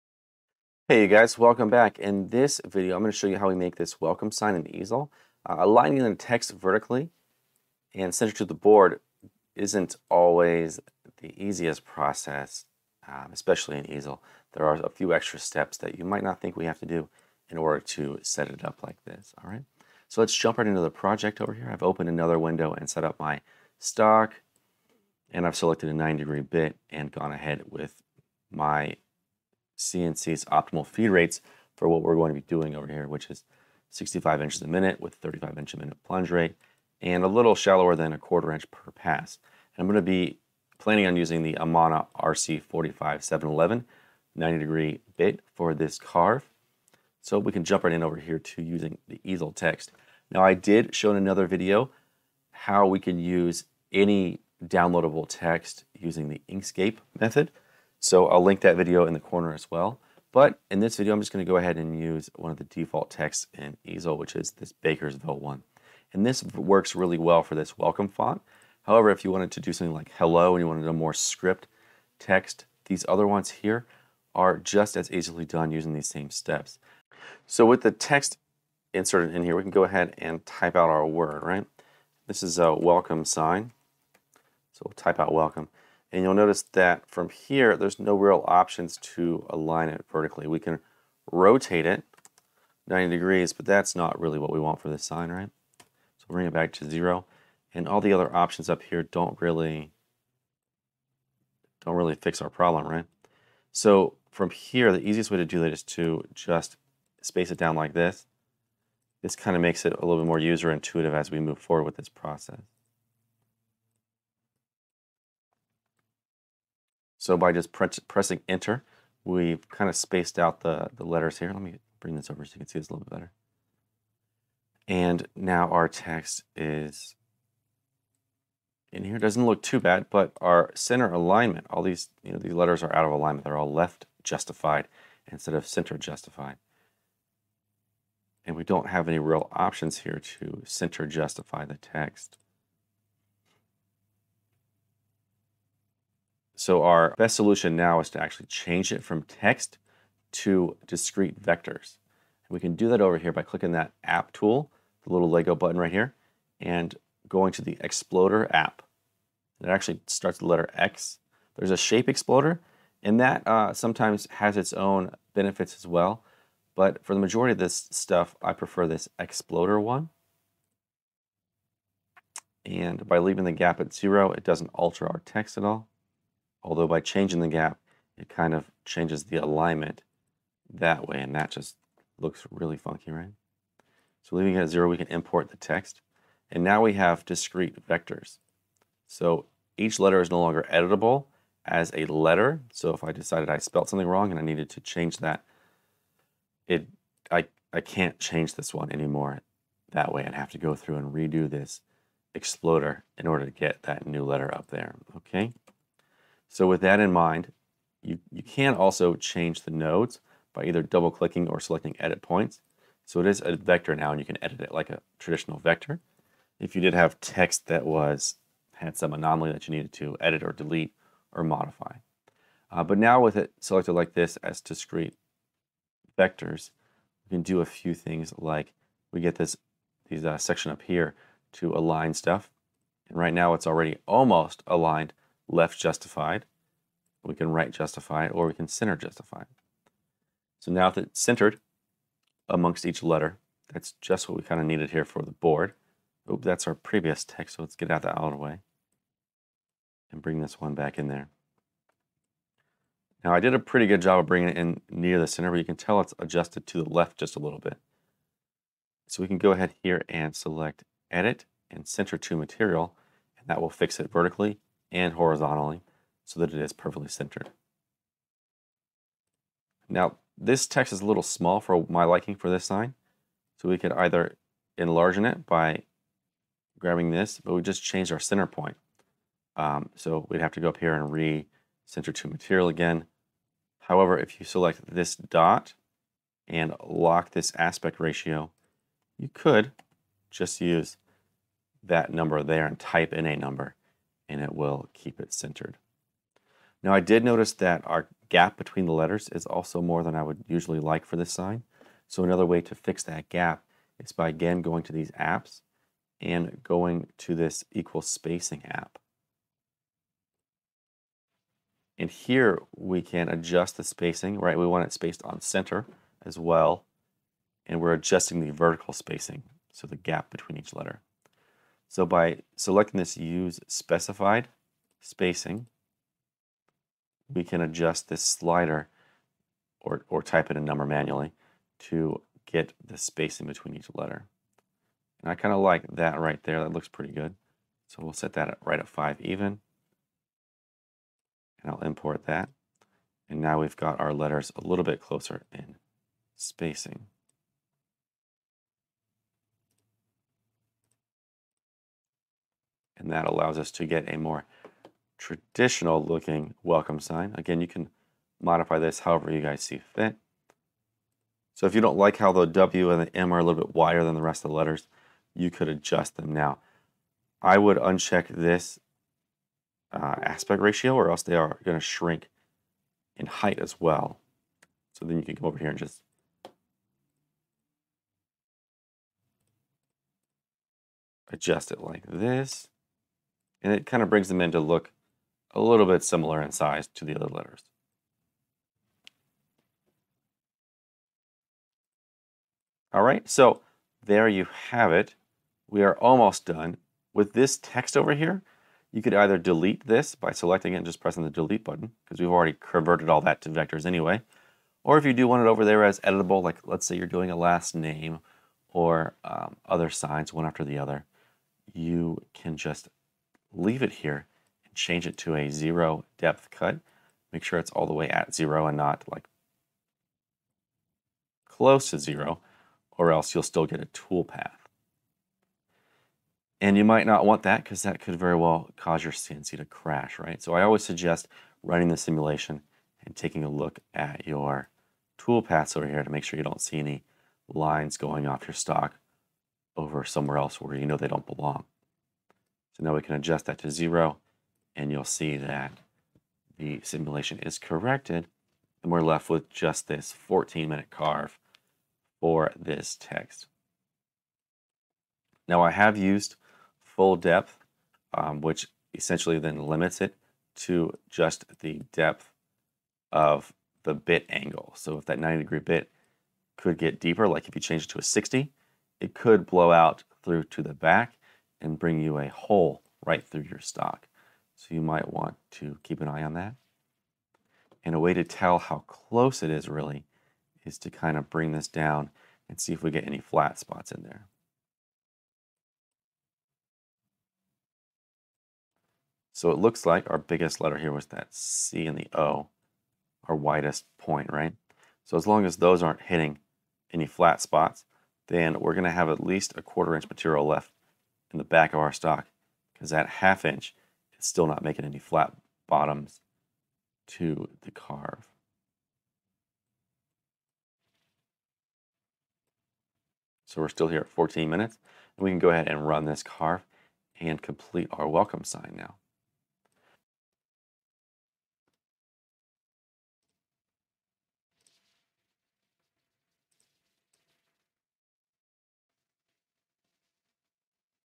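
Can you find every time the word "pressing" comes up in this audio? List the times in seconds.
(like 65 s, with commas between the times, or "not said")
118 s, 400 s.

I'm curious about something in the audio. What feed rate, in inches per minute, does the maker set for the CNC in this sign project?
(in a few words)
65 inches a minute.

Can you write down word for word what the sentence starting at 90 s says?
We can rotate it 90 degrees, but that's not really what we want for this sign, right?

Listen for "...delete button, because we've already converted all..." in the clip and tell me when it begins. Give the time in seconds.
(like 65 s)
401 s.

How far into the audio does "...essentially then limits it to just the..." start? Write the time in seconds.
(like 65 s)
458 s.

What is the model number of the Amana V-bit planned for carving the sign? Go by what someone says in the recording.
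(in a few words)
RC45711.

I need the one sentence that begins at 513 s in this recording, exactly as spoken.
So we're still here at 14 minutes and we can go ahead and run this carve and complete our welcome sign now.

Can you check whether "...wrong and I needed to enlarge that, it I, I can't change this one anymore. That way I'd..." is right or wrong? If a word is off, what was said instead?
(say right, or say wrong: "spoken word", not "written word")
wrong: "change", not "enlarge".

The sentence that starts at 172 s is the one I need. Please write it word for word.
And by leaving the gap at zero, it doesn't alter our text at all.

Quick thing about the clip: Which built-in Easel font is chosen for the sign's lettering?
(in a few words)
Bakersville.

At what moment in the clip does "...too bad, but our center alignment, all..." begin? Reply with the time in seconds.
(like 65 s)
129 s.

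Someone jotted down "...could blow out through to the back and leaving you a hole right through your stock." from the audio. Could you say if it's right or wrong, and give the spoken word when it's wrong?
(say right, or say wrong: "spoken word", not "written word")
wrong: "bring", not "leaving".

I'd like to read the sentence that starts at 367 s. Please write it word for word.
I would uncheck this uh, aspect ratio or else they are going to shrink in height as well.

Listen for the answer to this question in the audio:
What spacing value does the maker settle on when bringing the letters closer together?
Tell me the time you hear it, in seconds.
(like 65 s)
338 s.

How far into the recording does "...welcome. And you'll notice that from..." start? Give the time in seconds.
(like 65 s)
85 s.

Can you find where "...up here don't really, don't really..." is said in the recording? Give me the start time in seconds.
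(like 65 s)
98 s.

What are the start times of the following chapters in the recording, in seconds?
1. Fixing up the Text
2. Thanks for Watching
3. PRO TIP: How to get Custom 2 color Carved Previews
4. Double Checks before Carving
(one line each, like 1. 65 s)
1. 90 s
2. 510 s
3. 520 s
4. 360 s.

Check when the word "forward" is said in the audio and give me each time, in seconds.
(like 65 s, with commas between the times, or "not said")
111 s.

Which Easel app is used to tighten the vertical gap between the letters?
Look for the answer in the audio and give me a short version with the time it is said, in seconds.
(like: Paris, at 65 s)
equal spacing, at 307 s.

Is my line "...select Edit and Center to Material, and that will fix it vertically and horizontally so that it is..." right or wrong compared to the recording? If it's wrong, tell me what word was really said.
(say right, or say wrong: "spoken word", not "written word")
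right.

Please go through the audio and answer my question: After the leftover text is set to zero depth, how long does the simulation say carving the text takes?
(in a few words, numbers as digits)
14 minutes.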